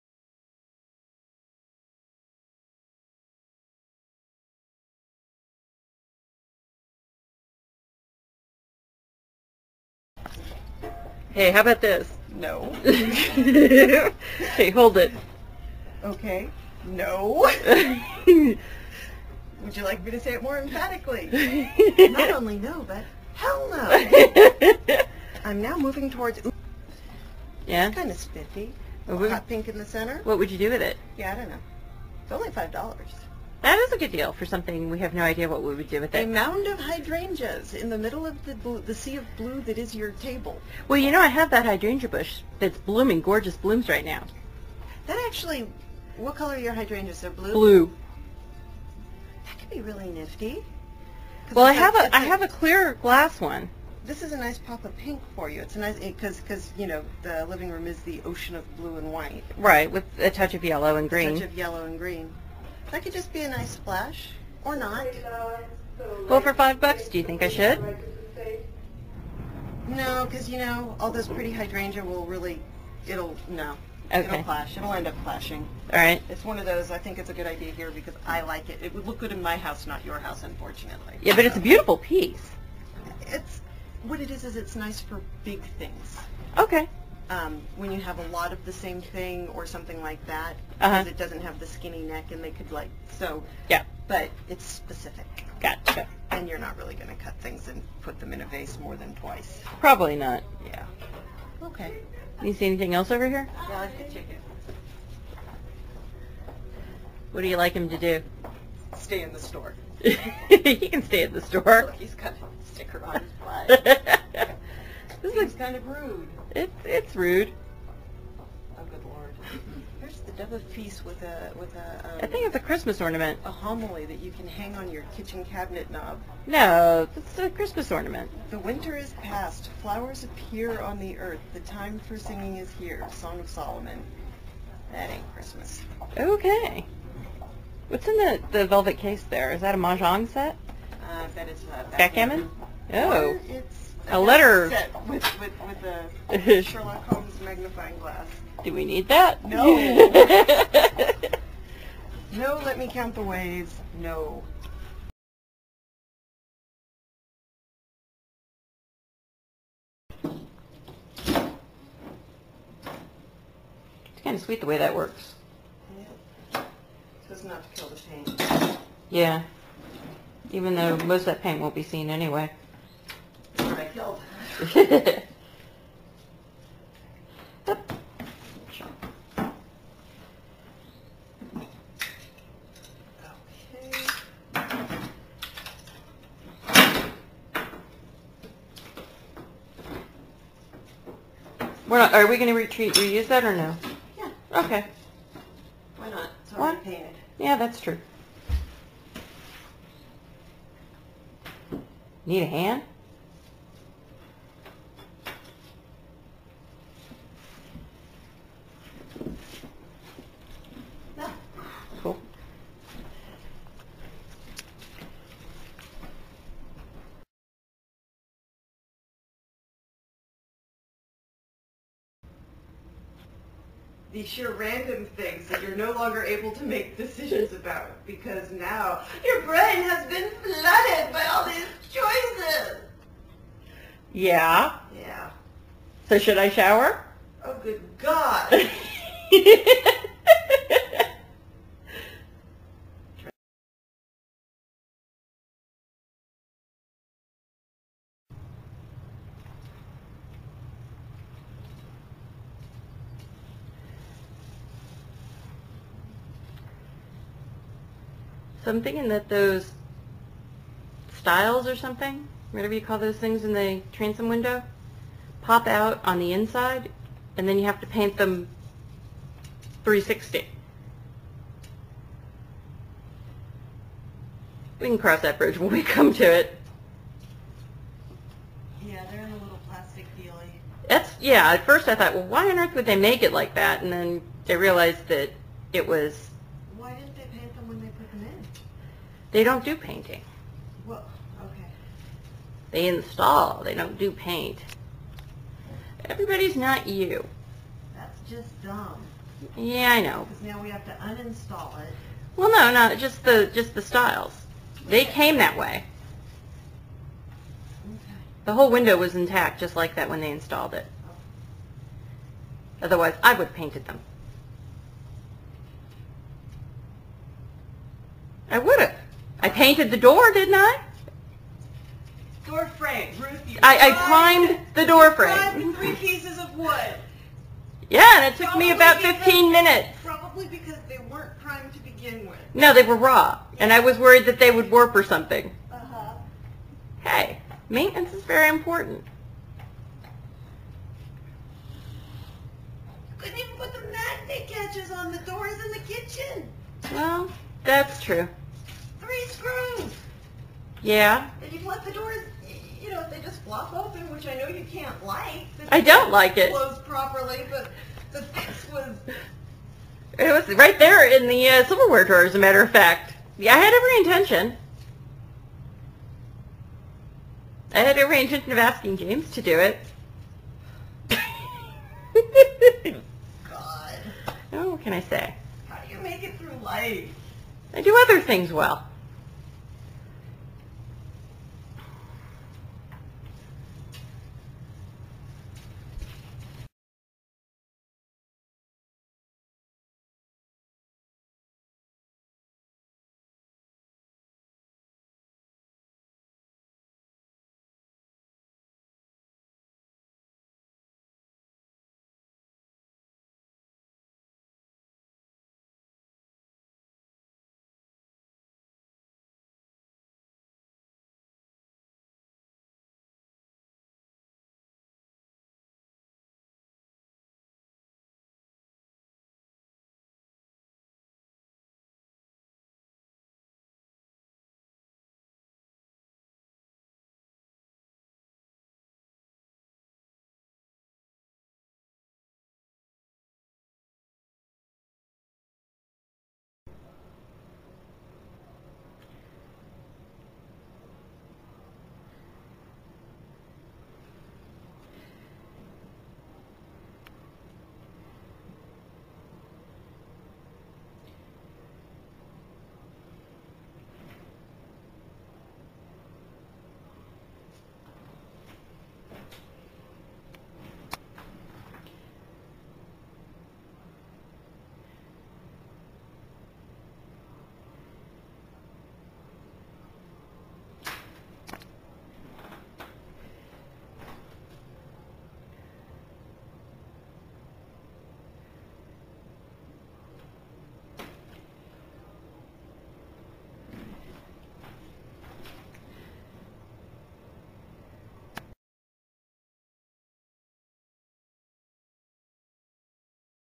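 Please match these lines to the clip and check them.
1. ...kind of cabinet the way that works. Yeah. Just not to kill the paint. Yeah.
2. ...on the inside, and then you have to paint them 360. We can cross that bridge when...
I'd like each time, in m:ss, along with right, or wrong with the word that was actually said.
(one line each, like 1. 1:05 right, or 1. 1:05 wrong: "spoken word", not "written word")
1. 2:44 wrong: "sweet", not "cabinet"
2. 4:26 right.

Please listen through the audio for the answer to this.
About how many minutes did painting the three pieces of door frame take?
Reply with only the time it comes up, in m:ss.
5:29.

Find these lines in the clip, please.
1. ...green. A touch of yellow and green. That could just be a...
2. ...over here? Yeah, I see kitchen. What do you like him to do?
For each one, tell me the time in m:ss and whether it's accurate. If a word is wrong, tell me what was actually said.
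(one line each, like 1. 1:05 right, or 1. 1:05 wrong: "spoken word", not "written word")
1. 1:01 right
2. 1:43 wrong: "chicken", not "kitchen".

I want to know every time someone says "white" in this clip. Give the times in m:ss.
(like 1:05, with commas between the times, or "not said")
0:59.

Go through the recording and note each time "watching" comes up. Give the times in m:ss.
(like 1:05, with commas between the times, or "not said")
not said.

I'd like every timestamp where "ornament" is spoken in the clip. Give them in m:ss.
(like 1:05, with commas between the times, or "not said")
2:02, 2:07.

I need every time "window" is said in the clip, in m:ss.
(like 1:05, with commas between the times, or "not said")
4:24, 5:08.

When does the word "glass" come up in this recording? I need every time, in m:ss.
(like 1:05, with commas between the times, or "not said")
0:52, 2:27.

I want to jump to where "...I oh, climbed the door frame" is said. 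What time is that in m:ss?
5:23.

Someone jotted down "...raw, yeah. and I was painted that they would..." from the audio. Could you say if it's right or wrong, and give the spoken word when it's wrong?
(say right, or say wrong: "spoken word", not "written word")
wrong: "worried", not "painted".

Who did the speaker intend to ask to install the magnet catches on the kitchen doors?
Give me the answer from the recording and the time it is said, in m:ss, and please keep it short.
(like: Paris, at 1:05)
James, at 6:08.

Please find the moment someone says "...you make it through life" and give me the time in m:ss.
6:15.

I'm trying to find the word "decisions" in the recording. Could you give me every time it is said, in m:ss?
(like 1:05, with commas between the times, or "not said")
3:46.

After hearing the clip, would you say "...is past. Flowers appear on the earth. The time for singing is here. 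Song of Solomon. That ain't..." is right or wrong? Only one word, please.
right.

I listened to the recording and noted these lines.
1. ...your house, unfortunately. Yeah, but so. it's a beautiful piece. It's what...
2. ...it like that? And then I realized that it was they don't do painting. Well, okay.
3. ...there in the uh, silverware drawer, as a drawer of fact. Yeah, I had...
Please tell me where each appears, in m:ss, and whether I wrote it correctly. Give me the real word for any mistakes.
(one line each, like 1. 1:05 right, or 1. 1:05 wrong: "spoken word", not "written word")
1. 1:20 right
2. 4:43 right
3. 6:00 wrong: "matter", not "drawer".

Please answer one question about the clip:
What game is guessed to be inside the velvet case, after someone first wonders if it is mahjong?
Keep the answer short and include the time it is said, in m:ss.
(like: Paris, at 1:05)
Backgammon, at 2:21.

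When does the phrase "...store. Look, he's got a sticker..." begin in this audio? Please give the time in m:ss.
1:51.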